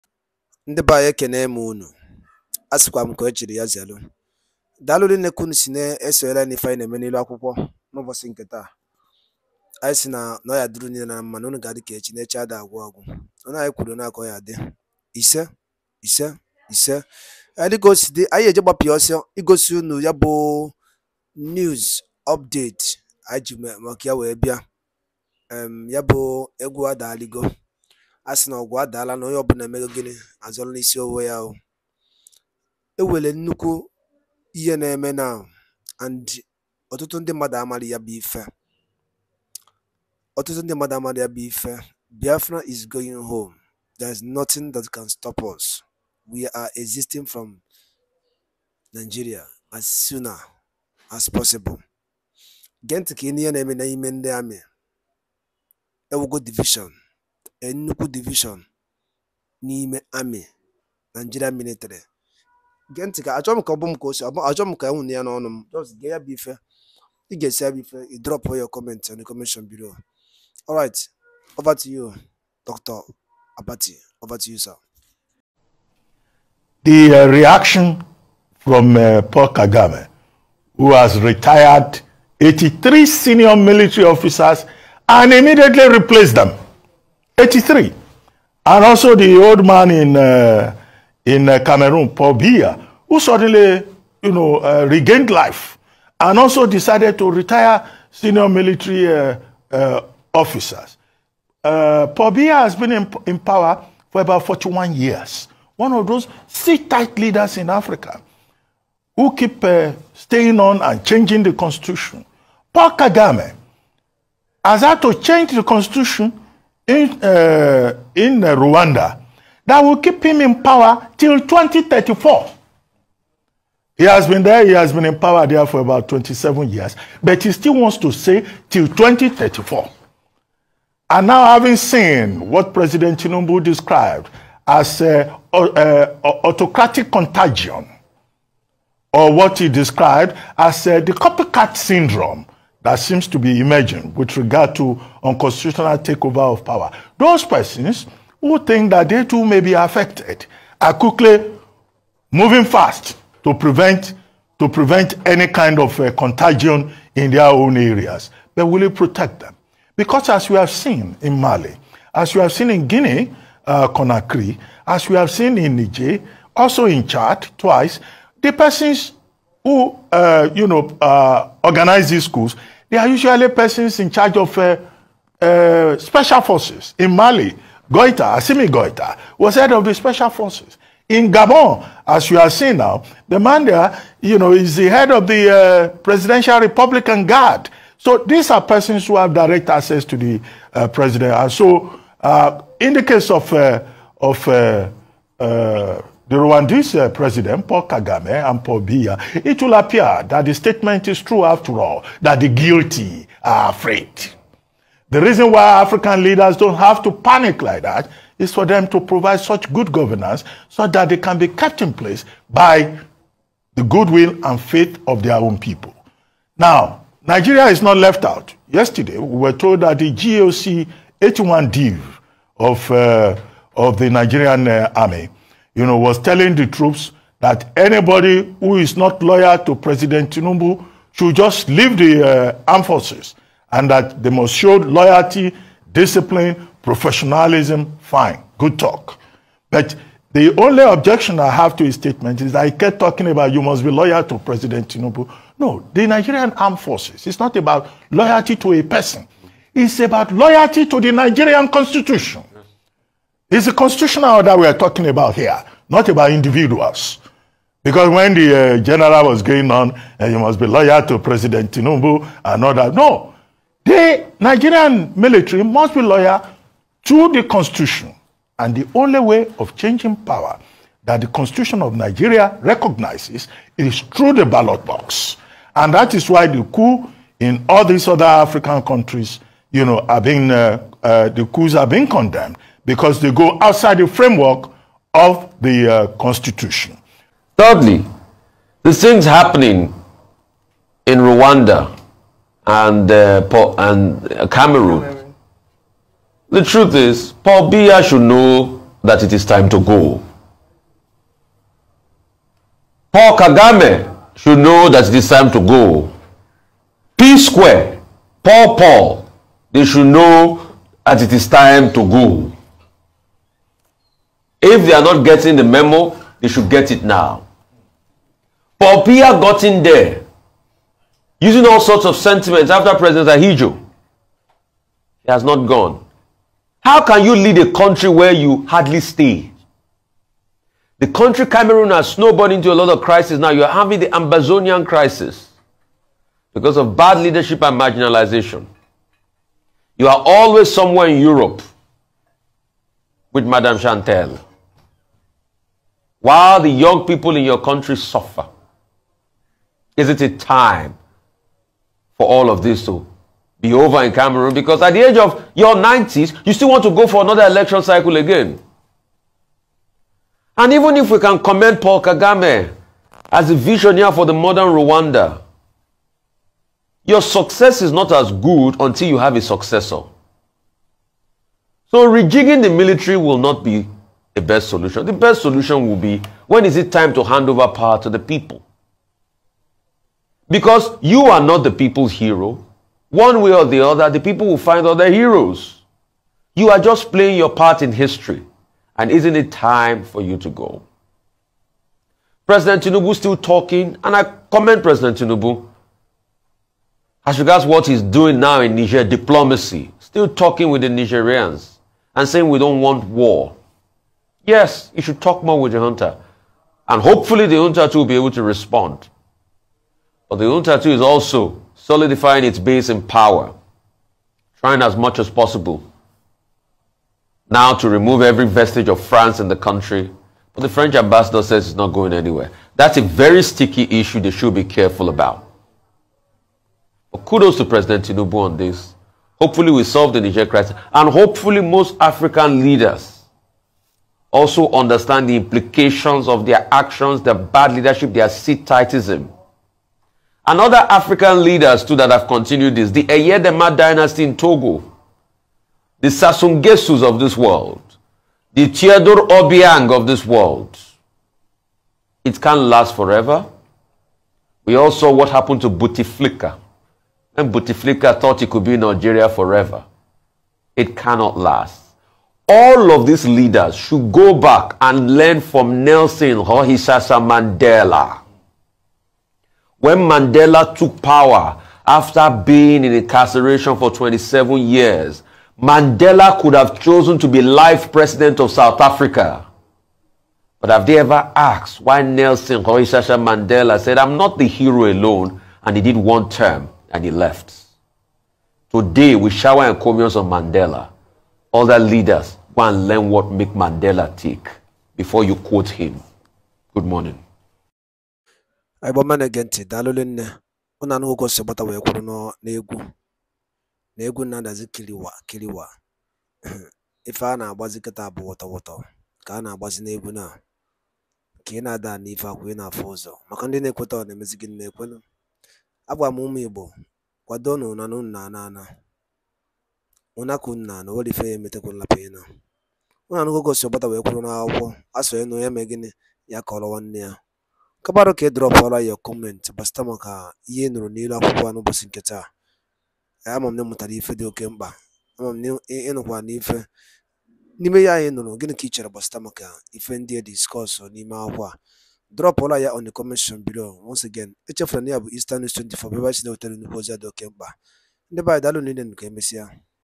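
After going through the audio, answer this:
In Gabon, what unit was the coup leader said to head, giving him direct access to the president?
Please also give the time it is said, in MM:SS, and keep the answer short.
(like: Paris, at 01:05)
Presidential Republican Guard, at 03:05.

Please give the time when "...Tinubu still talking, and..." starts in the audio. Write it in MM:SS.
06:32.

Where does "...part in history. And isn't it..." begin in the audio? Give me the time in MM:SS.
06:27.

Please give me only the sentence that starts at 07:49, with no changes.
When Mandela took power after being in incarceration for 27 years, Mandela could have chosen to be life president of South Africa.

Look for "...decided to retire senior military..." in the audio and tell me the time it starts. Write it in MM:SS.
01:36.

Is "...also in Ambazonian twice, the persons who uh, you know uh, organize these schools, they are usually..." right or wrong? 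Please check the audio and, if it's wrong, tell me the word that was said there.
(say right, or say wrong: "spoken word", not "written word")
wrong: "Chad", not "Ambazonian".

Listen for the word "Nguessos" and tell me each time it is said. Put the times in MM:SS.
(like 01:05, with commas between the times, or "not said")
07:26.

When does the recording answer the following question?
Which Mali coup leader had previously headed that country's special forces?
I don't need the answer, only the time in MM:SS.
02:58.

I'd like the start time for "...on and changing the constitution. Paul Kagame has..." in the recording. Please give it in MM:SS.
01:50.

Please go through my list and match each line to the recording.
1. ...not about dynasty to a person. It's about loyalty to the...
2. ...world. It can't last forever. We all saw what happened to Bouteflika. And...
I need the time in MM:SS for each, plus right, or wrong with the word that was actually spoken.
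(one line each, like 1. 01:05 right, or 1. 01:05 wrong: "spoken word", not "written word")
1. 04:07 wrong: "loyalty", not "dynasty"
2. 07:30 right.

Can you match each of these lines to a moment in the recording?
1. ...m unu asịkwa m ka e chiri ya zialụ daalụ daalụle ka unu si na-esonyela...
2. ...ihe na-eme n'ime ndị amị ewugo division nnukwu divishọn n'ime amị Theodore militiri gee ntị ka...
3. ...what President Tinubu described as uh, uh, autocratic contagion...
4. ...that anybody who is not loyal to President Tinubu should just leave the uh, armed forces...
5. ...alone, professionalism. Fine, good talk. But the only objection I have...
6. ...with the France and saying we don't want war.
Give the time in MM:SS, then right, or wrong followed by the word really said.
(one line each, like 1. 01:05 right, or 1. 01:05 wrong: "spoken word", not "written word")
1. 00:01 wrong: "niile", not "daalụle"
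2. 00:53 wrong: "Naịjirịa", not "Theodore"
3. 02:12 right
4. 03:47 right
5. 03:55 wrong: "discipline", not "alone"
6. 06:40 wrong: "Nigerians", not "France".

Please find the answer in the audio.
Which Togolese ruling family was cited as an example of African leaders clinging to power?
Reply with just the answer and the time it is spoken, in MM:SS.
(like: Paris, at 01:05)
Eyadema dynasty, at 07:23.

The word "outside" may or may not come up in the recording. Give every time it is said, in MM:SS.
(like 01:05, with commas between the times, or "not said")
04:43.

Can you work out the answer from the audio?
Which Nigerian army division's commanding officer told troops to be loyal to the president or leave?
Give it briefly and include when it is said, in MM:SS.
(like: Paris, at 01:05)
81 Division, at 03:41.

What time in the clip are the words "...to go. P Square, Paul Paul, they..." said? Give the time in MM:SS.
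05:05.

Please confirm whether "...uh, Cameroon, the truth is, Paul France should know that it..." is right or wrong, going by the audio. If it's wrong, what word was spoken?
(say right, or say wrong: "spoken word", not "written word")
wrong: "Biya", not "France".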